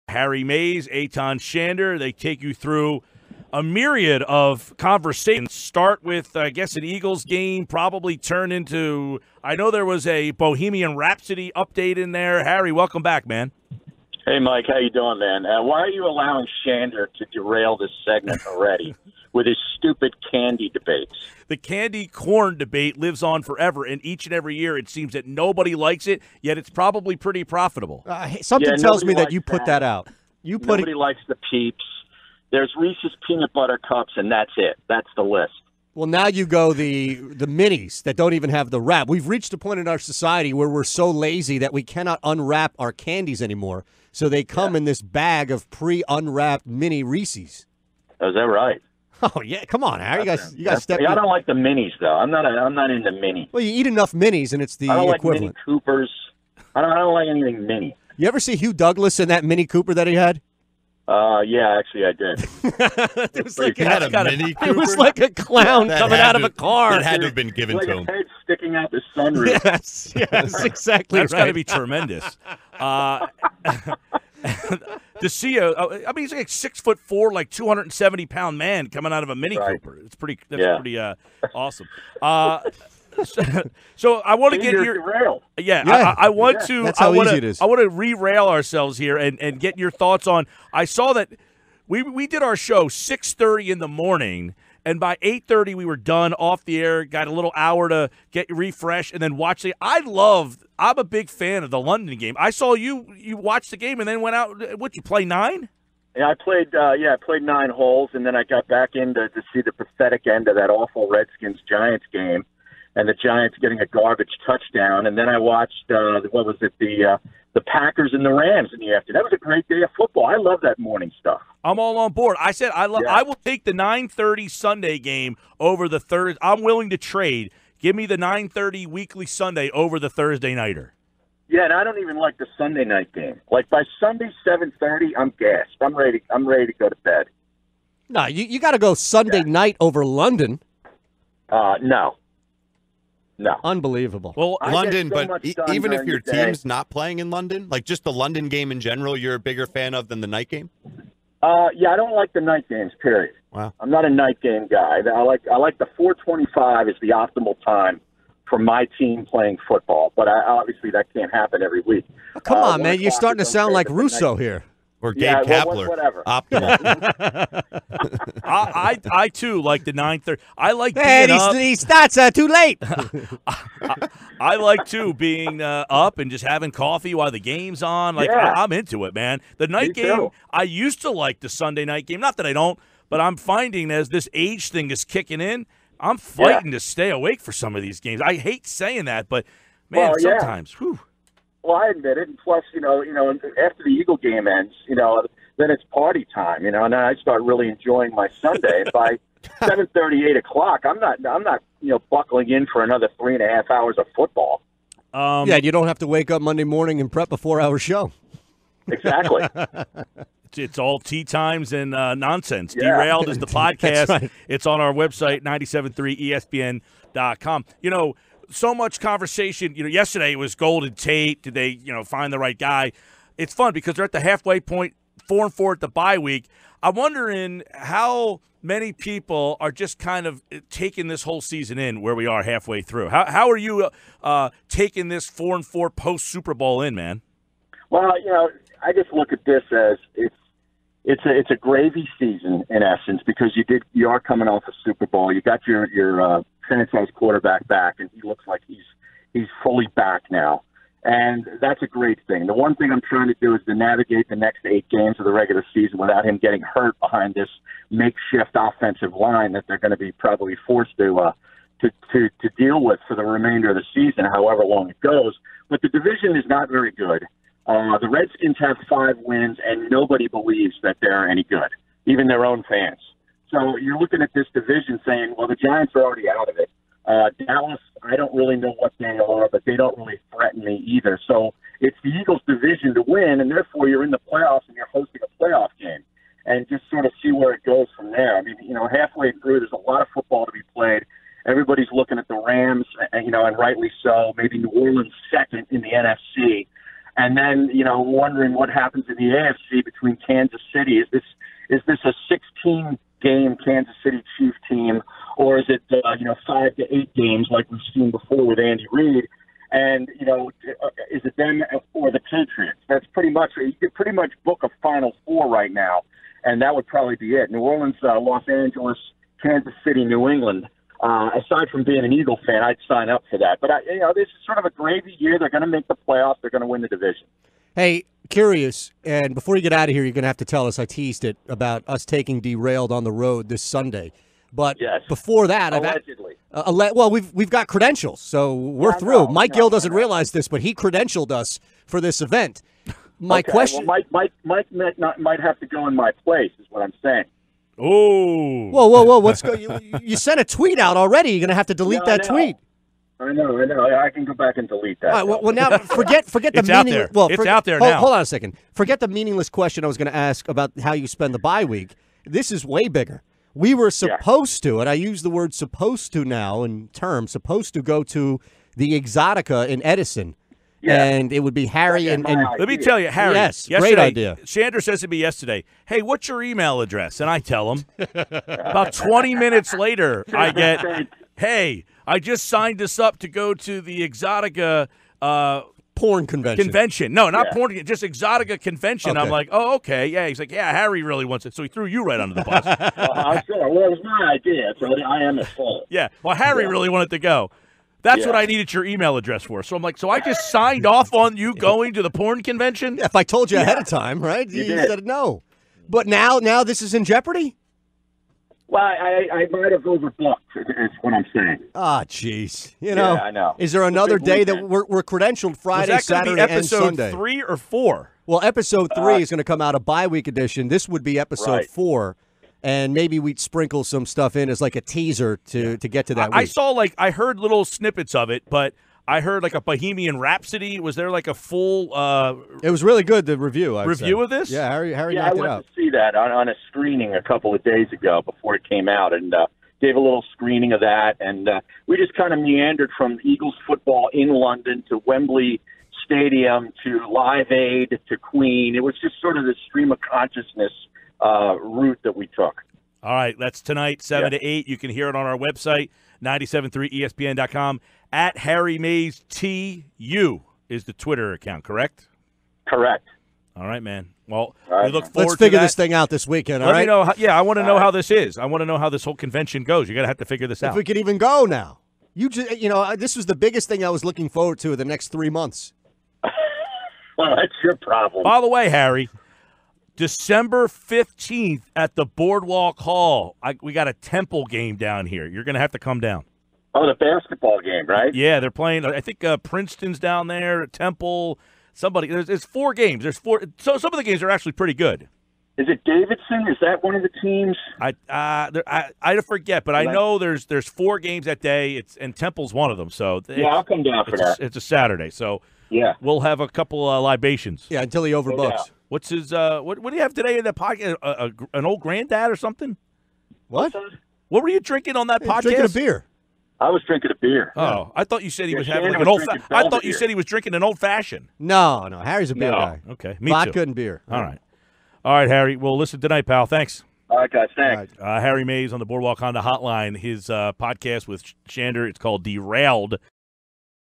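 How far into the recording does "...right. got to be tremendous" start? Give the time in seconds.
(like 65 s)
71 s.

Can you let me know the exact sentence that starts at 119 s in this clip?
That was a great day of football.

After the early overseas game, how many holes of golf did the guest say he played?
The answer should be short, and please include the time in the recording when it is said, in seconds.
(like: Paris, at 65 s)
9, at 107 s.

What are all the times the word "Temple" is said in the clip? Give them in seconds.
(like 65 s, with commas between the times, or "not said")
483 s, 490 s, 502 s.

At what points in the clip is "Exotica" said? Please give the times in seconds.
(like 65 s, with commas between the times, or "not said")
368 s, 384 s, 388 s.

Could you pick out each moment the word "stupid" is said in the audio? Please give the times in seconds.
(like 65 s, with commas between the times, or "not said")
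19 s.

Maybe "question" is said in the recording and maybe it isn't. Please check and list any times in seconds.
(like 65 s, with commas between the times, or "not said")
343 s, 359 s.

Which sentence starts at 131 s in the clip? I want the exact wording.
Yeah, and I don't even like the Sunday night game.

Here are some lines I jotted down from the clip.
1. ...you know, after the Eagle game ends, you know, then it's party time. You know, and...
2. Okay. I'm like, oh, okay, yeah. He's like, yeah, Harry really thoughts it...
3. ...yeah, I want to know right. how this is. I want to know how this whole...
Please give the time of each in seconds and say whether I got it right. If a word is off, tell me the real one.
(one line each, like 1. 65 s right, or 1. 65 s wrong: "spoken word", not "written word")
1. 193 s right
2. 389 s wrong: "wants", not "thoughts"
3. 467 s right.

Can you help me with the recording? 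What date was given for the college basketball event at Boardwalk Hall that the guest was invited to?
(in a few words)
December 15th.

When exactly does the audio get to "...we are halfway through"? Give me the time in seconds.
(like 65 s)
232 s.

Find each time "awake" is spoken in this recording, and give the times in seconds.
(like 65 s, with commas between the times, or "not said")
187 s.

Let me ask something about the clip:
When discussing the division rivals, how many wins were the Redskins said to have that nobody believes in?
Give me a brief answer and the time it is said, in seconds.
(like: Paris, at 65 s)
5, at 268 s.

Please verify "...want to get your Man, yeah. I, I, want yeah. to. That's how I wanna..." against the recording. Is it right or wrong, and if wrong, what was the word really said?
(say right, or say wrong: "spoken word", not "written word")
wrong: "Yeah", not "Man".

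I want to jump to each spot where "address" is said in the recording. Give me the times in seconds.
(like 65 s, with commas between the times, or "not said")
376 s, 399 s.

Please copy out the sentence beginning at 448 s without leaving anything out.
It was just sort of the stream of consciousness uh, route that we took.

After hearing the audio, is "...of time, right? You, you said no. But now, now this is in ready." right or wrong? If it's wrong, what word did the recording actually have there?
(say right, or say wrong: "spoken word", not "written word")
wrong: "jeopardy", not "ready".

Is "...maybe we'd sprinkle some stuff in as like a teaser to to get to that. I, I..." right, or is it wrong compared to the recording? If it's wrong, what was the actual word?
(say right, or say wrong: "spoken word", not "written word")
right.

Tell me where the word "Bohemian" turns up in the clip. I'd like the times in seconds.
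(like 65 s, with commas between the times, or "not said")
10 s, 429 s.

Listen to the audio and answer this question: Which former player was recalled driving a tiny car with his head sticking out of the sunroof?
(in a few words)
Hugh Douglas.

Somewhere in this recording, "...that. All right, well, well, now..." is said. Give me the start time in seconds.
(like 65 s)
355 s.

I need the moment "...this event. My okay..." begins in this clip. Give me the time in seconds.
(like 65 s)
342 s.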